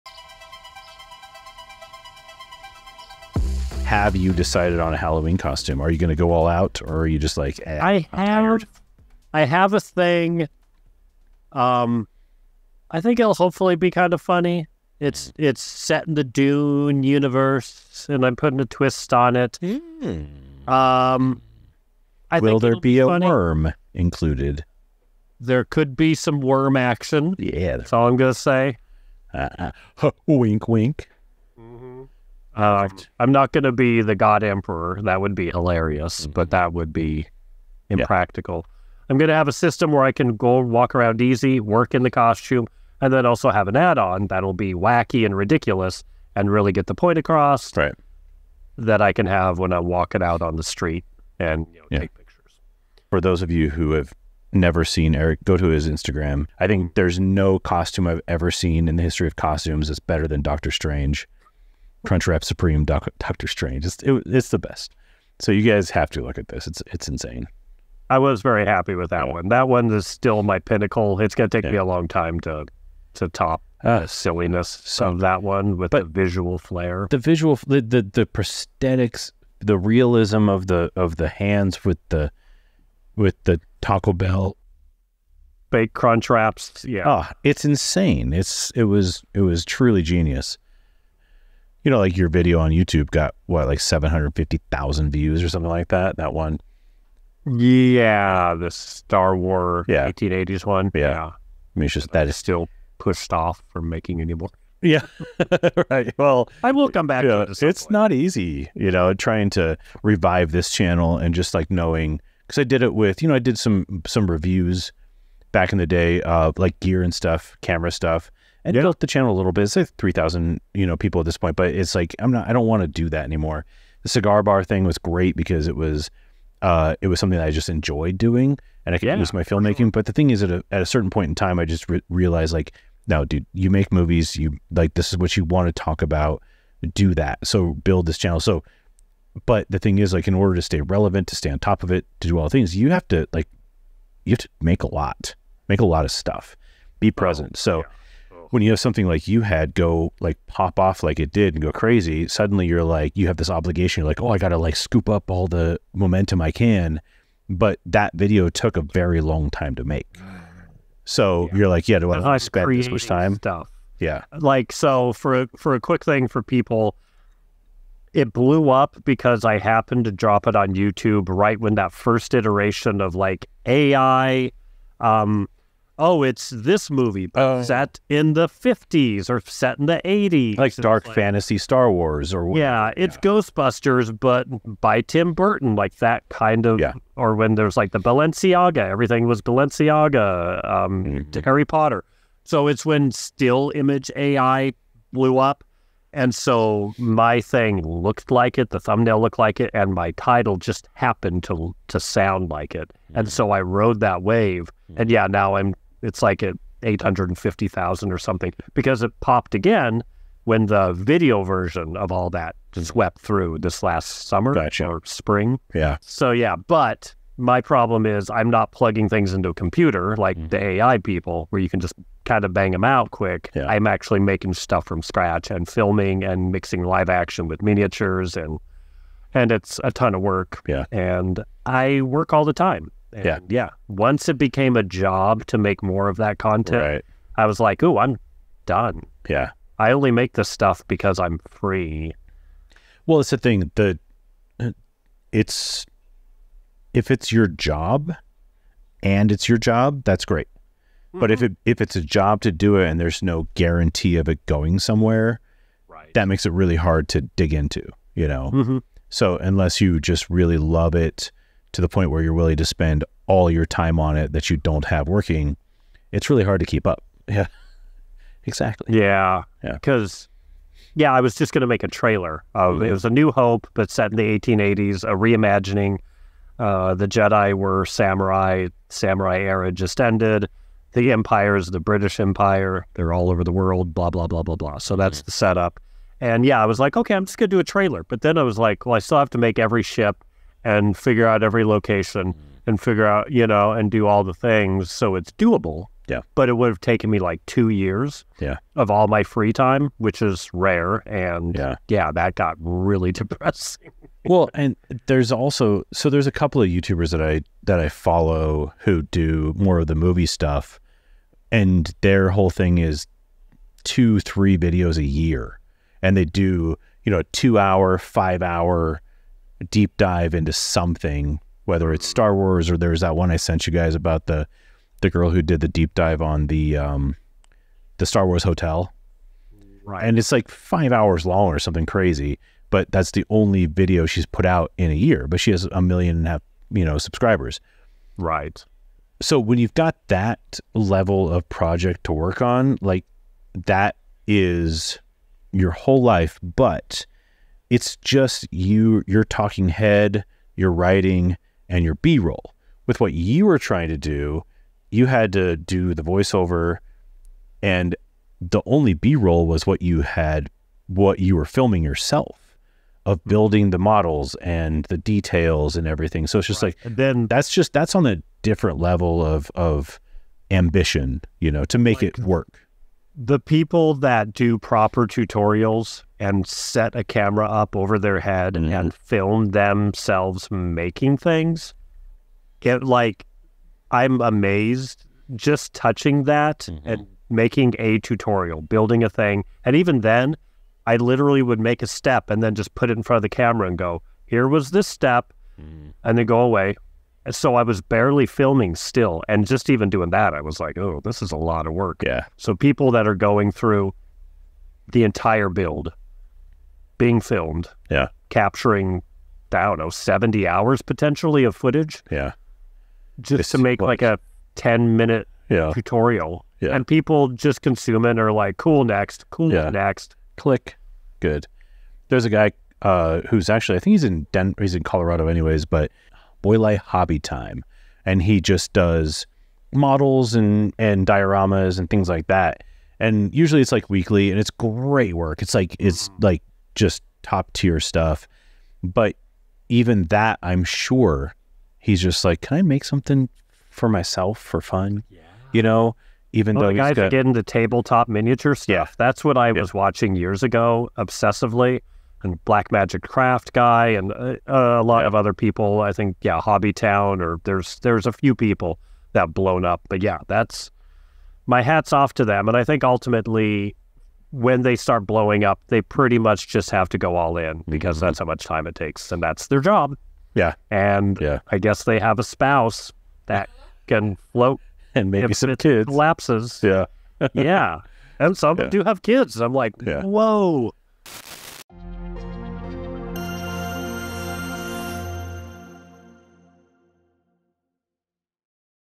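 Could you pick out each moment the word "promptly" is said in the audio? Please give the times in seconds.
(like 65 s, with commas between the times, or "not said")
not said.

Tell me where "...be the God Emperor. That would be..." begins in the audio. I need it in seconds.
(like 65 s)
33 s.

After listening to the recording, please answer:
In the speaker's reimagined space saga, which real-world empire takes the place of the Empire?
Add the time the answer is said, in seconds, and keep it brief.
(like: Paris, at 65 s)
British Empire, at 281 s.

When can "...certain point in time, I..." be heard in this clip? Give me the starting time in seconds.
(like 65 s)
130 s.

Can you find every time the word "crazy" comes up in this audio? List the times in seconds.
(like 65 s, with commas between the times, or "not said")
151 s, 331 s.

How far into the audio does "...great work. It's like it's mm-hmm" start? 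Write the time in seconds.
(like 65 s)
434 s.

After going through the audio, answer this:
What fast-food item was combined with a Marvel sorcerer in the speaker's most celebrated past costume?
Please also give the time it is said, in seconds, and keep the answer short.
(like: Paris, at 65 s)
Crunchwrap Supreme, at 62 s.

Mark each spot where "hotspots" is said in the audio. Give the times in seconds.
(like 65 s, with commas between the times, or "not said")
not said.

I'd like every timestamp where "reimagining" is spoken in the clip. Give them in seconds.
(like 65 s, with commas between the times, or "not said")
275 s.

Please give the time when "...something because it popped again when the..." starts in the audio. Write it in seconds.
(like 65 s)
208 s.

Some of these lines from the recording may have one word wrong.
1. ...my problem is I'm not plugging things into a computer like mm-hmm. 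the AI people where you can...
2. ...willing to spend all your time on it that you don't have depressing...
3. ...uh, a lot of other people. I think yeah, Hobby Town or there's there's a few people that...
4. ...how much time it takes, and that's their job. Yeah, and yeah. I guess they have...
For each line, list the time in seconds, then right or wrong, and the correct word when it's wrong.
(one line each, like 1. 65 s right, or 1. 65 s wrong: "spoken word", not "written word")
1. 217 s right
2. 262 s wrong: "working", not "depressing"
3. 454 s right
4. 468 s right.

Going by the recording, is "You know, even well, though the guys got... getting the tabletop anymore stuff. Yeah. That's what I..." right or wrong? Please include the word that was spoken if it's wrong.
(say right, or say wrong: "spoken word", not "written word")
wrong: "miniature", not "anymore".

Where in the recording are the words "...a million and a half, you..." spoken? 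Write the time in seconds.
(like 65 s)
335 s.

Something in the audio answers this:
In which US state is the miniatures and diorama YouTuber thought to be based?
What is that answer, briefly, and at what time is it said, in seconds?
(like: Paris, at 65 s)
Colorado, at 424 s.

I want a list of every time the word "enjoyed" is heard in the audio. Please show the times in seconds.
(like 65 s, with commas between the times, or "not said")
127 s.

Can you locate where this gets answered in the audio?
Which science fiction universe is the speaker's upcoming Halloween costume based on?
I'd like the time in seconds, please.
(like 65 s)
16 s.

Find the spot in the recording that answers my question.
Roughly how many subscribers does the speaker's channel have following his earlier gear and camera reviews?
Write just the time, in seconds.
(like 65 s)
119 s.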